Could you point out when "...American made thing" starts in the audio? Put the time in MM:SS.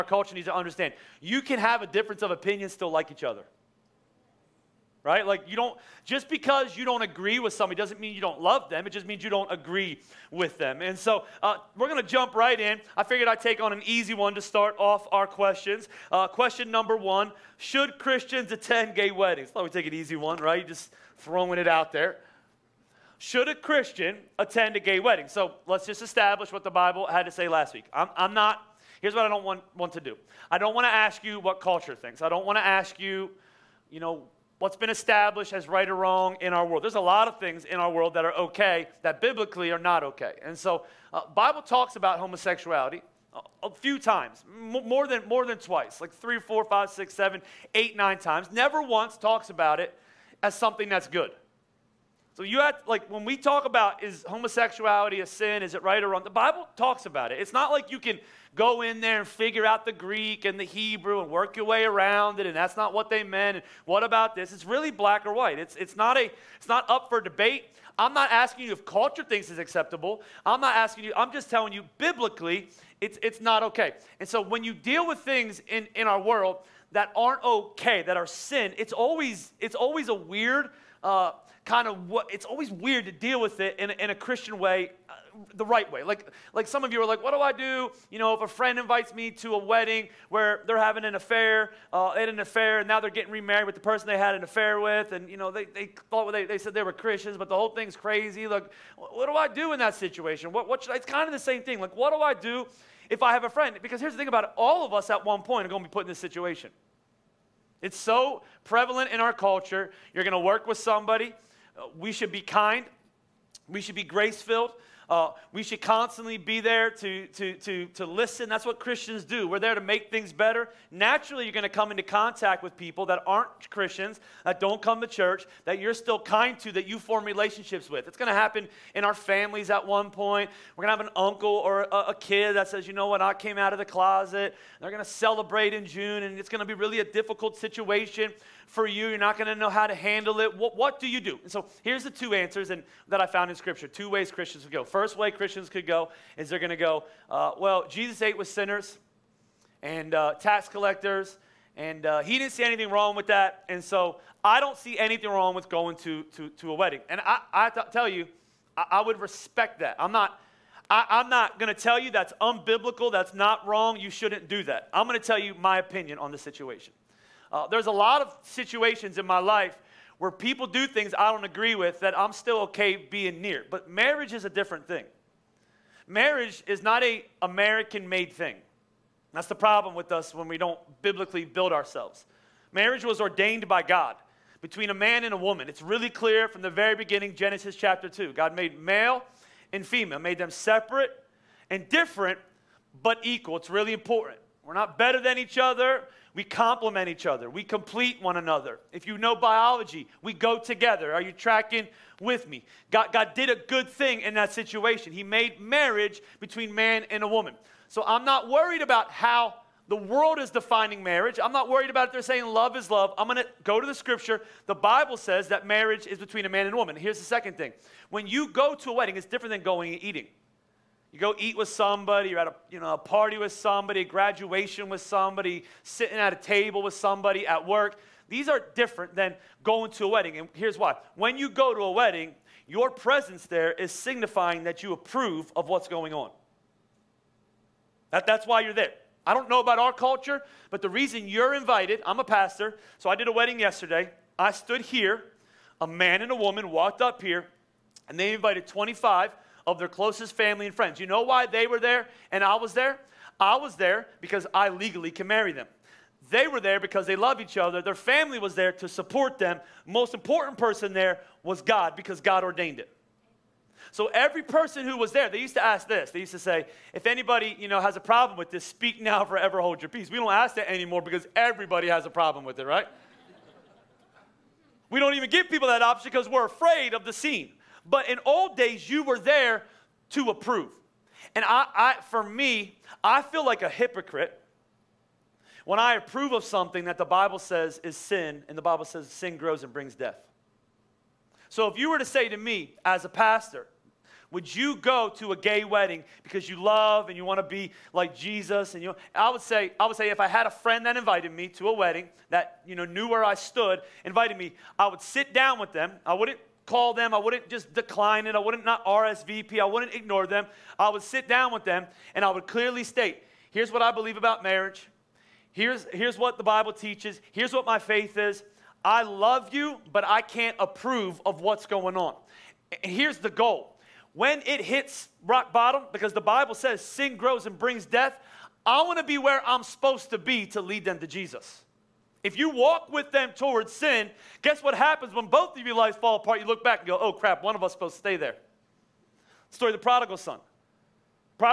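02:57.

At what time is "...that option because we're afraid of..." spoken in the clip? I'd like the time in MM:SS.
04:35.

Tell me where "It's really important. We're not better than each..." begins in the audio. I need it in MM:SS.
03:13.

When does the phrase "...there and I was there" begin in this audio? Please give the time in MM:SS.
04:11.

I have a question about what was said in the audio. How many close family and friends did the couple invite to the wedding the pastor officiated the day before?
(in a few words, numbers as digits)
25.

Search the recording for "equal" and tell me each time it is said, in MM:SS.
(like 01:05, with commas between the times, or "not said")
03:13.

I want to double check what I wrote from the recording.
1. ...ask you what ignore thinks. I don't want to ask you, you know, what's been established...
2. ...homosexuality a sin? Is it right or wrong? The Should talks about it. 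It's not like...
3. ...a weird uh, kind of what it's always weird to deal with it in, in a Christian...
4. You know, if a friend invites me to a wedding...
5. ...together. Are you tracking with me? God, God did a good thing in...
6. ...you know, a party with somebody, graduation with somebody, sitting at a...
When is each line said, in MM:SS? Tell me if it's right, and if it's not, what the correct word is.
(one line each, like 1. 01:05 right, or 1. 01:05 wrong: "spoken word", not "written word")
1. 00:30 wrong: "culture", not "ignore"
2. 00:54 wrong: "Bible", not "Should"
3. 01:20 right
4. 01:28 right
5. 03:20 right
6. 03:42 right.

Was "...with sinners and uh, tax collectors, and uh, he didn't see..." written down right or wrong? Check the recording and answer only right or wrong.
right.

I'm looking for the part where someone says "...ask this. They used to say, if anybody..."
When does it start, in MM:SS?
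04:25.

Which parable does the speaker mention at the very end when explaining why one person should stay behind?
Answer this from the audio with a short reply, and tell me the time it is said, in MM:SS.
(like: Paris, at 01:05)
The prodigal son, at 05:39.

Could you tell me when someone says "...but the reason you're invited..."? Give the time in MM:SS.
04:00.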